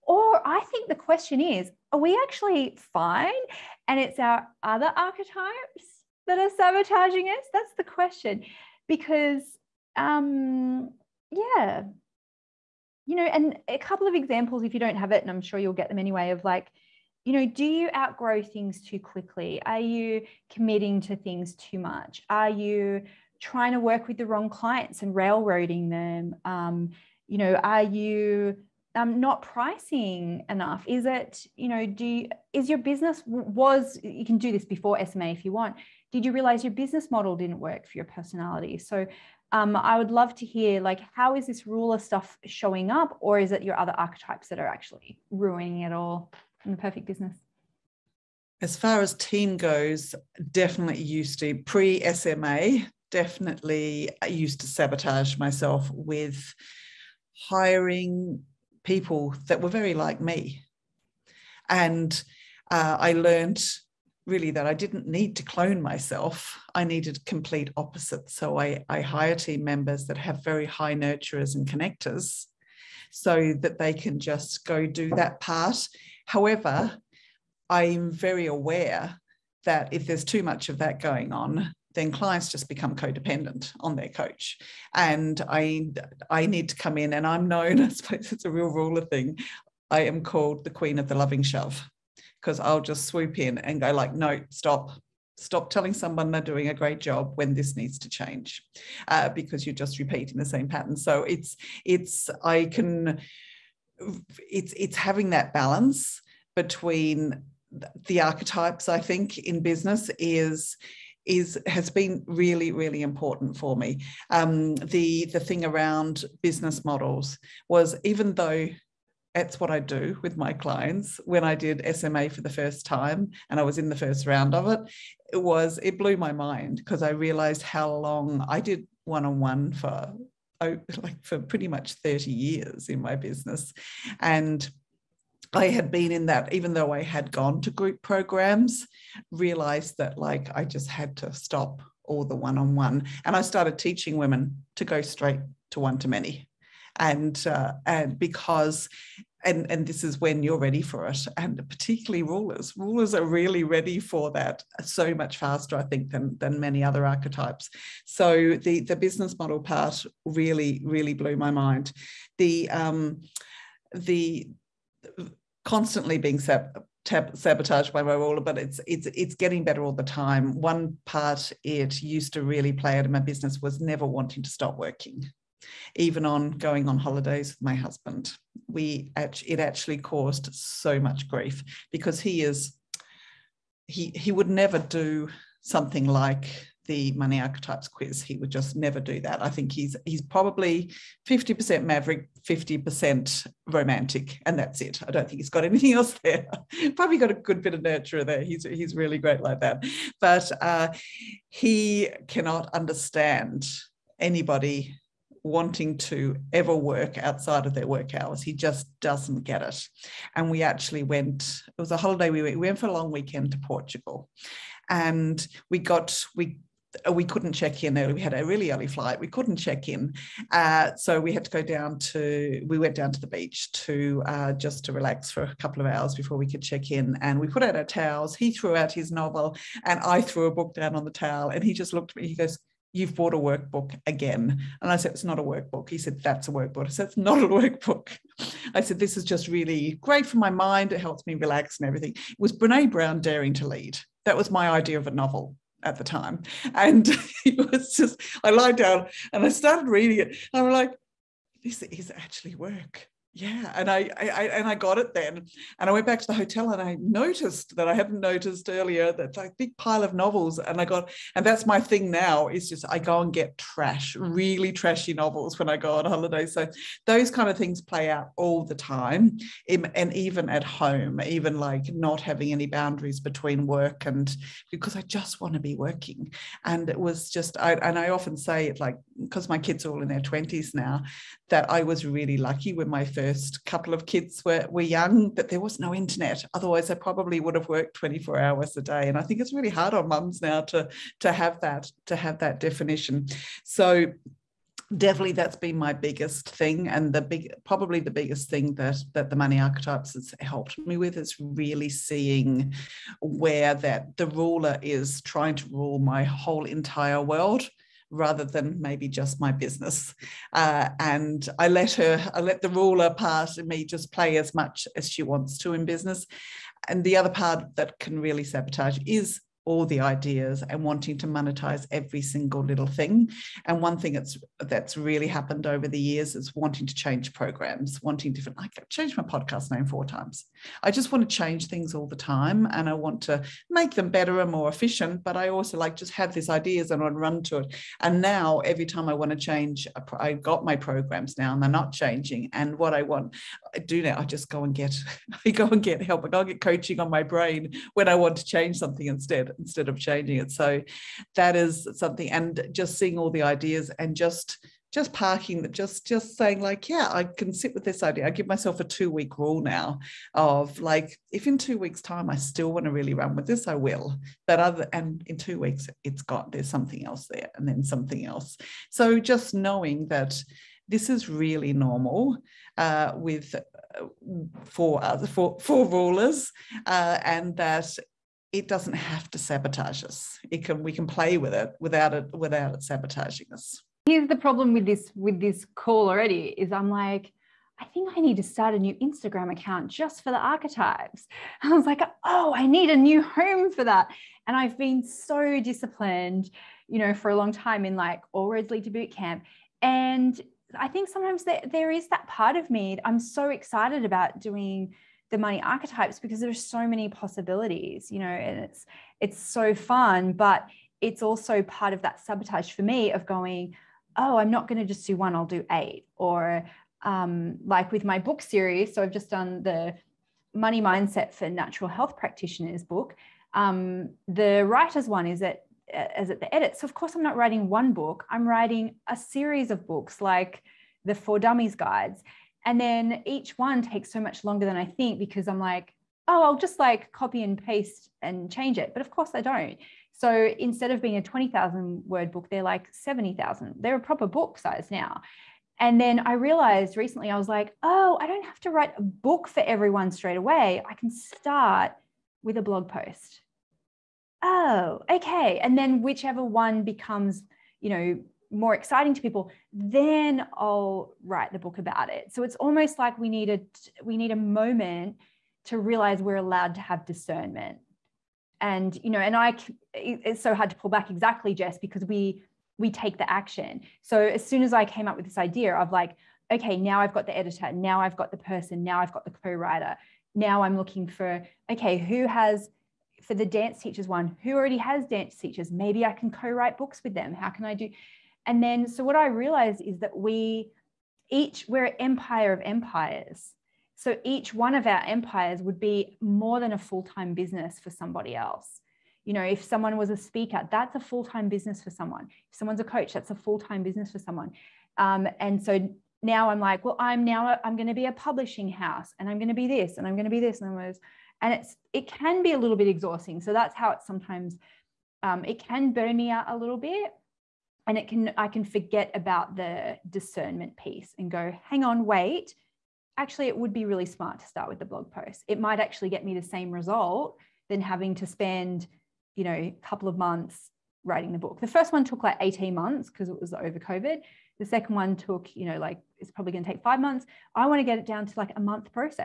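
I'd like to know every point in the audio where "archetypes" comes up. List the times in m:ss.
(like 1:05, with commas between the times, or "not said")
0:04, 0:43, 1:48, 2:37, 3:07, 4:59, 6:30, 6:45.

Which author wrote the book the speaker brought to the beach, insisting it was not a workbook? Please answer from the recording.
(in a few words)
Brene Brown.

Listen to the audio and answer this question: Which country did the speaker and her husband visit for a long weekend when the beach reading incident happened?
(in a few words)
Portugal.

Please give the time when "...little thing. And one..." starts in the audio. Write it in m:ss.
5:22.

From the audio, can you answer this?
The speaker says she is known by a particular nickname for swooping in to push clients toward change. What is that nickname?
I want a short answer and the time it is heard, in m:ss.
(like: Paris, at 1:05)
Queen of the loving shove, at 1:30.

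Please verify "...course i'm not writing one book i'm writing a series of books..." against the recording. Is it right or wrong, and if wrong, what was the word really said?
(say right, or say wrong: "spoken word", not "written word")
right.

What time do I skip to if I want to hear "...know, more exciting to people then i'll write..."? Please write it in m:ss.
7:37.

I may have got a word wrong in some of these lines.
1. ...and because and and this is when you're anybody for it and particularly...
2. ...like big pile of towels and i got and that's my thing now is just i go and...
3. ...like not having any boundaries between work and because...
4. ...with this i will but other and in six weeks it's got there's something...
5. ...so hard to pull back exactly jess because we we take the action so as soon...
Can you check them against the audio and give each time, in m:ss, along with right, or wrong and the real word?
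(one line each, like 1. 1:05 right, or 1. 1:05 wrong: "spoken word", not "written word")
1. 2:27 wrong: "ready", not "anybody"
2. 4:19 wrong: "novels", not "towels"
3. 4:31 right
4. 6:03 wrong: "two", not "six"
5. 7:50 right.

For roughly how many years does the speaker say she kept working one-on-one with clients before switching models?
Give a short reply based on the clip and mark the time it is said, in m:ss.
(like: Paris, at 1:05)
30, at 2:11.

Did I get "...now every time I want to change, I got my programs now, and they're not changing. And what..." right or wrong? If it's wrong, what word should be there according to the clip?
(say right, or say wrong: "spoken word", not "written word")
right.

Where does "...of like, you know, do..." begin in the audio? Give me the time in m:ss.
0:16.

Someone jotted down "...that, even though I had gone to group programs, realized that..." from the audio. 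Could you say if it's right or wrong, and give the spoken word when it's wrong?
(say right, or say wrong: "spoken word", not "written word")
right.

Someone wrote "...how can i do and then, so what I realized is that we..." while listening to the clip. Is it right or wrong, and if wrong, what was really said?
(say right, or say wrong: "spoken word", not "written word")
right.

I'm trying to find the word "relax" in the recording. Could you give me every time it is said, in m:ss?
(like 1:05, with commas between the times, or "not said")
3:44, 4:01.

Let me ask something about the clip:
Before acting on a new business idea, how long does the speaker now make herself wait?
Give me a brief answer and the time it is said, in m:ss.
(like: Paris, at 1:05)
2 weeks, at 5:58.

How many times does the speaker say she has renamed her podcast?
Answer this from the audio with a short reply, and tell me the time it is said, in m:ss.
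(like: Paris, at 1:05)
4, at 5:29.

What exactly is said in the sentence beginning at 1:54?
Um, the the thing around business models was even though that's what I do with my clients.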